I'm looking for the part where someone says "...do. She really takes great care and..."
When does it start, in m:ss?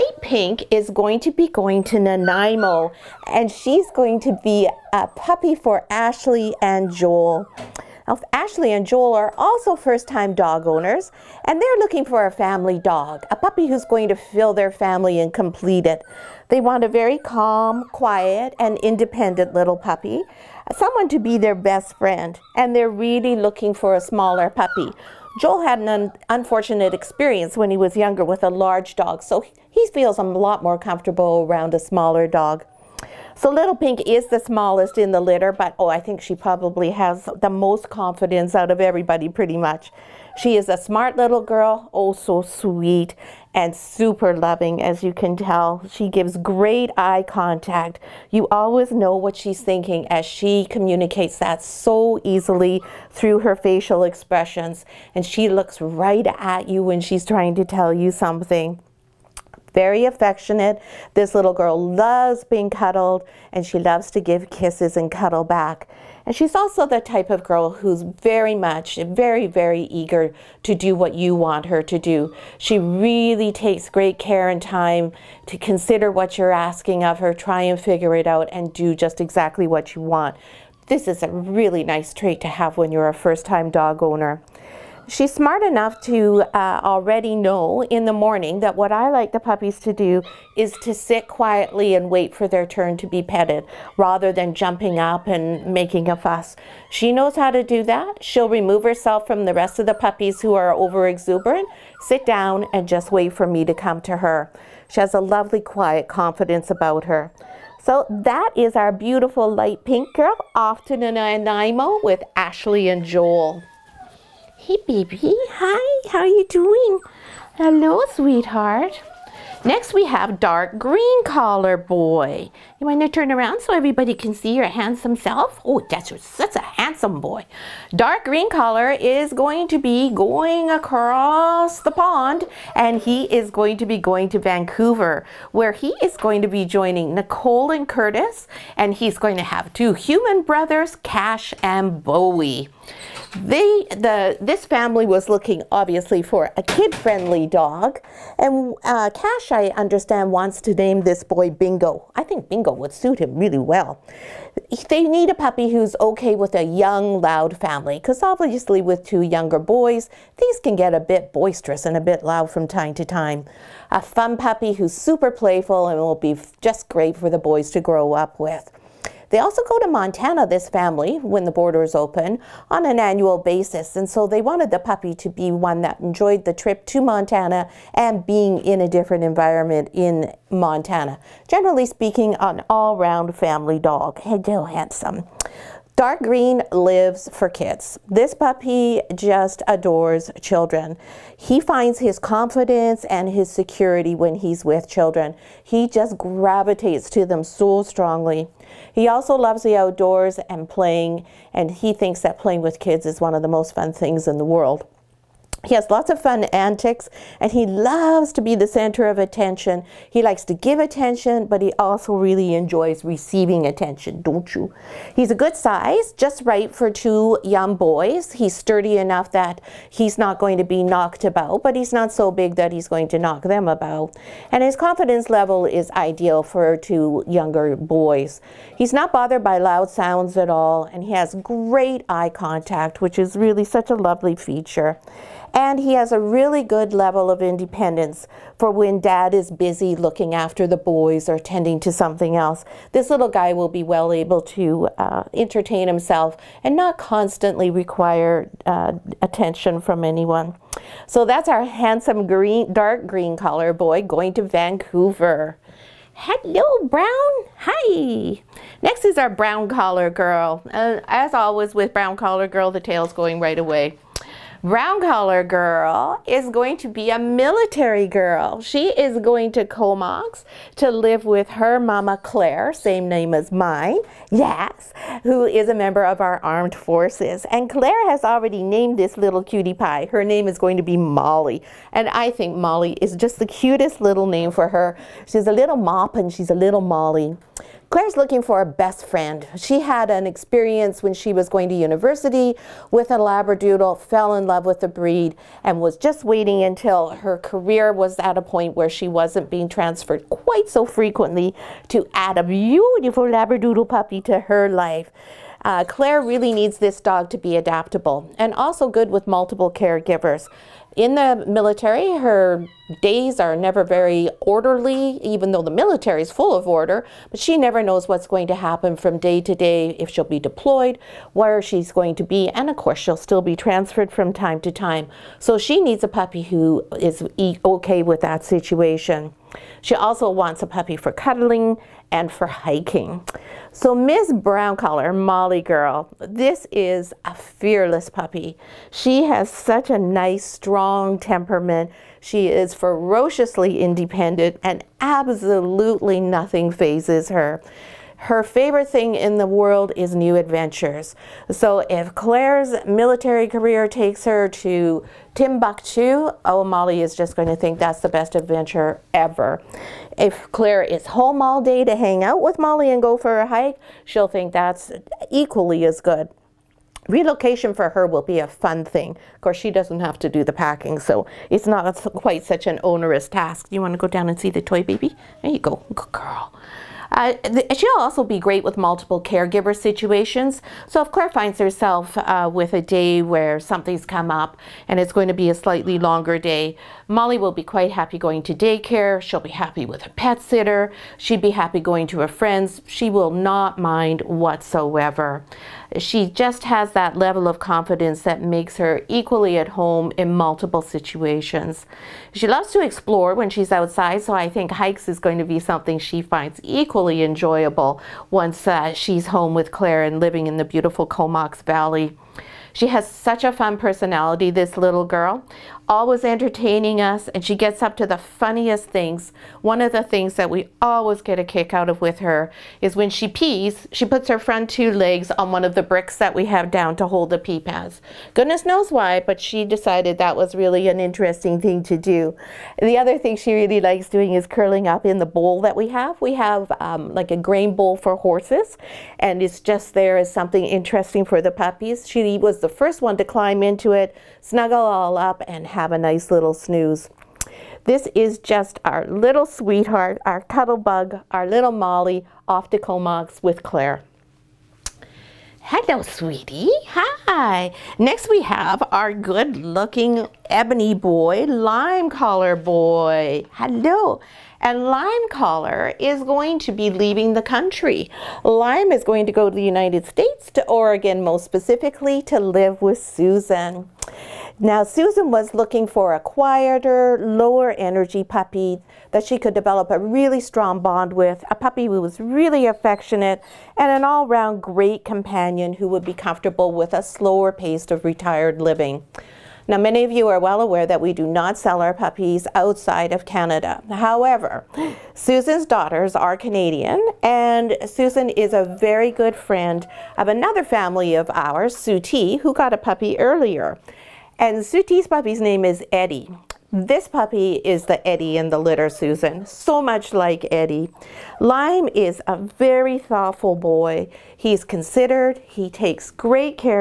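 1:11.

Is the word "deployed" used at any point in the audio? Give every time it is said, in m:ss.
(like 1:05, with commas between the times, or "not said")
5:20.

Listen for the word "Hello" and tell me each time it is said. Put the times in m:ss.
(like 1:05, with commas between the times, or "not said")
1:57, 4:16, 7:35, 7:43.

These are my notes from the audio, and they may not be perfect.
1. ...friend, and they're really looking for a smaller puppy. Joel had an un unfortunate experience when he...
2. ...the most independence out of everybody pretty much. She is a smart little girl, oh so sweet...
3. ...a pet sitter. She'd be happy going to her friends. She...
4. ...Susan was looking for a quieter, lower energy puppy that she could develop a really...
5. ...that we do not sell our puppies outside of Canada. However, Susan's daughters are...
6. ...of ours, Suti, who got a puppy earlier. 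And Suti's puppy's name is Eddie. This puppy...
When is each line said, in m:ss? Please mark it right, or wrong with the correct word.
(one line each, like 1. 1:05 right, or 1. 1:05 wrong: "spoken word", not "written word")
1. 0:21 right
2. 0:37 wrong: "confidence", not "independence"
3. 6:30 right
4. 7:54 right
5. 8:10 right
6. 8:21 right.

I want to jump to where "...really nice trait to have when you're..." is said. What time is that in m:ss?
1:21.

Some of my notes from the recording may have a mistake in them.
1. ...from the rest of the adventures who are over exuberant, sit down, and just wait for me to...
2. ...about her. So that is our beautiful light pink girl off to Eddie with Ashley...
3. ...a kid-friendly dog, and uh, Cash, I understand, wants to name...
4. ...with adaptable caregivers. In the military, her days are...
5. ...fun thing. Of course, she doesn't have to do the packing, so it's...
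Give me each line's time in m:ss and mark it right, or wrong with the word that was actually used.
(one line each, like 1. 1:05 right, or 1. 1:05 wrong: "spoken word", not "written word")
1. 1:39 wrong: "puppies", not "adventures"
2. 1:46 wrong: "Nanaimo", not "Eddie"
3. 2:26 right
4. 5:09 wrong: "multiple", not "adaptable"
5. 6:08 right.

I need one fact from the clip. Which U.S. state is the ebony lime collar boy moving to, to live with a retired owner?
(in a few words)
Oregon.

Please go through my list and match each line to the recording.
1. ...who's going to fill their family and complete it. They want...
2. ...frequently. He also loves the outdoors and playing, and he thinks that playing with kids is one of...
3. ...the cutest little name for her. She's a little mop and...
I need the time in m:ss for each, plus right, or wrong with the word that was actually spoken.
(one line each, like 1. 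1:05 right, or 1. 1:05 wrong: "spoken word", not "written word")
1. 0:13 right
2. 3:17 wrong: "strongly", not "frequently"
3. 4:43 right.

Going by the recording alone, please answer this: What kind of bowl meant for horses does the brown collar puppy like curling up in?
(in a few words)
grain bowl.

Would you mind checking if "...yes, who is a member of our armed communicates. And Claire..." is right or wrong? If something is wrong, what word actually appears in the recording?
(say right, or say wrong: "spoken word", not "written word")
wrong: "forces", not "communicates".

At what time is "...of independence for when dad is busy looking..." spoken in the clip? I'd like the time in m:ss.
3:57.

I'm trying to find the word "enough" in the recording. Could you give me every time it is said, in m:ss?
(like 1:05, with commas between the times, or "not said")
1:25, 3:38.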